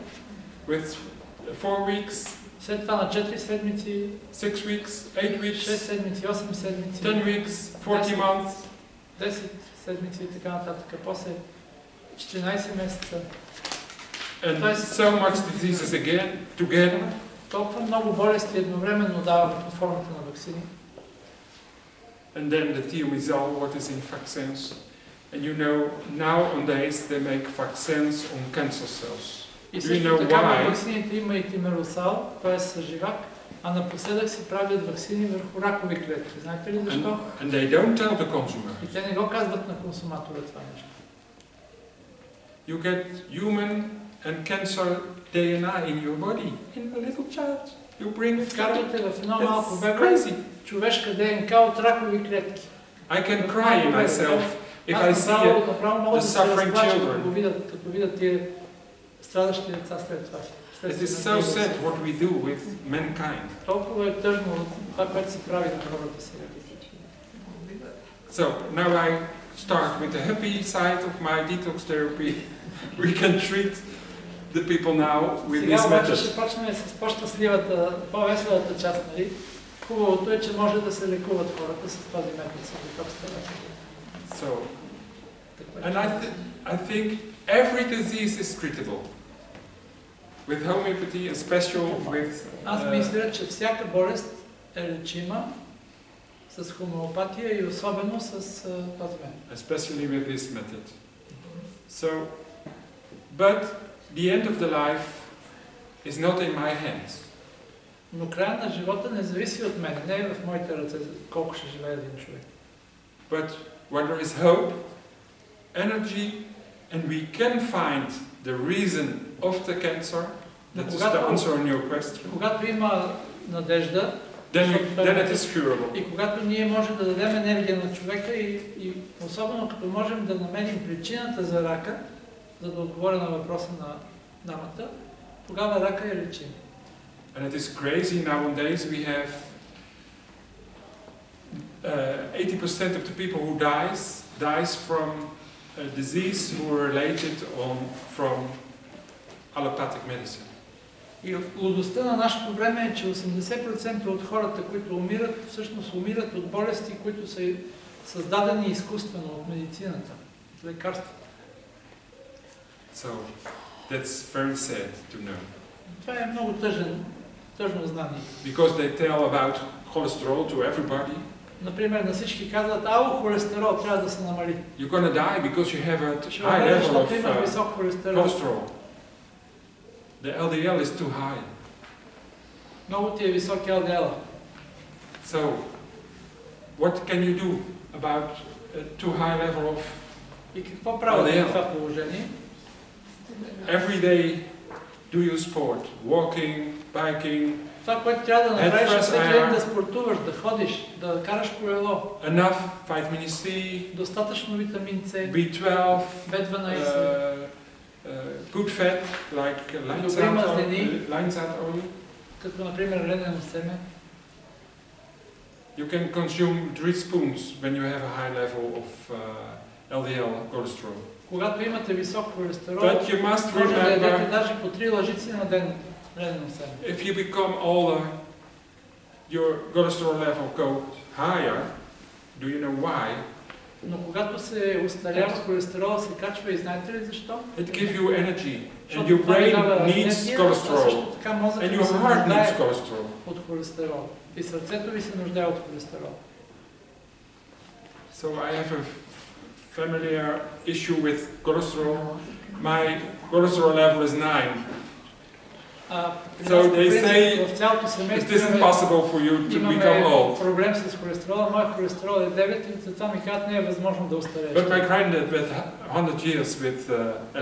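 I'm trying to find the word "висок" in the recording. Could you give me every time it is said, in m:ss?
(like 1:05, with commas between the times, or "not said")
3:41.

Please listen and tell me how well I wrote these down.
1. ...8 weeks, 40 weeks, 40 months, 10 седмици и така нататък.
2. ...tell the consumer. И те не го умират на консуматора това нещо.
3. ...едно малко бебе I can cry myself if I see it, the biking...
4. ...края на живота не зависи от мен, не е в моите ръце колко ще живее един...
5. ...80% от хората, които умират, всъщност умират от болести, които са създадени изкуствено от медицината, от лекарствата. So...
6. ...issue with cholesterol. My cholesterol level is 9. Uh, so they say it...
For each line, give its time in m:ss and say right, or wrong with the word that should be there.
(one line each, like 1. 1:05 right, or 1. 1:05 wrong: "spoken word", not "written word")
1. 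0:05 wrong: "10", not "40"
2. 0:38 wrong: "казват", not "умират"
3. 0:49 wrong: "suffering", not "biking"
4. 1:48 right
5. 2:33 right
6. 4:10 right.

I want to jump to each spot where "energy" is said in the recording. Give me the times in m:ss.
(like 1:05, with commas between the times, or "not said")
1:55, 3:58.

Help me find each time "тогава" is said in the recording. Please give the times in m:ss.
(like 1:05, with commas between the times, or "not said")
2:15.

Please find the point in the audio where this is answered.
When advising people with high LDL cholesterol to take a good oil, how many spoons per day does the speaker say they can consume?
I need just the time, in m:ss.
3:36.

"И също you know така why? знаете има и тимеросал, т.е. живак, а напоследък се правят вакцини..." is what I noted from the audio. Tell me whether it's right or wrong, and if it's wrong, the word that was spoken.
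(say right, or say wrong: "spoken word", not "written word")
wrong: "вакцините", not "знаете".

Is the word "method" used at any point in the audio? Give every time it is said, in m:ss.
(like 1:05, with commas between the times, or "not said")
1:15, 1:40.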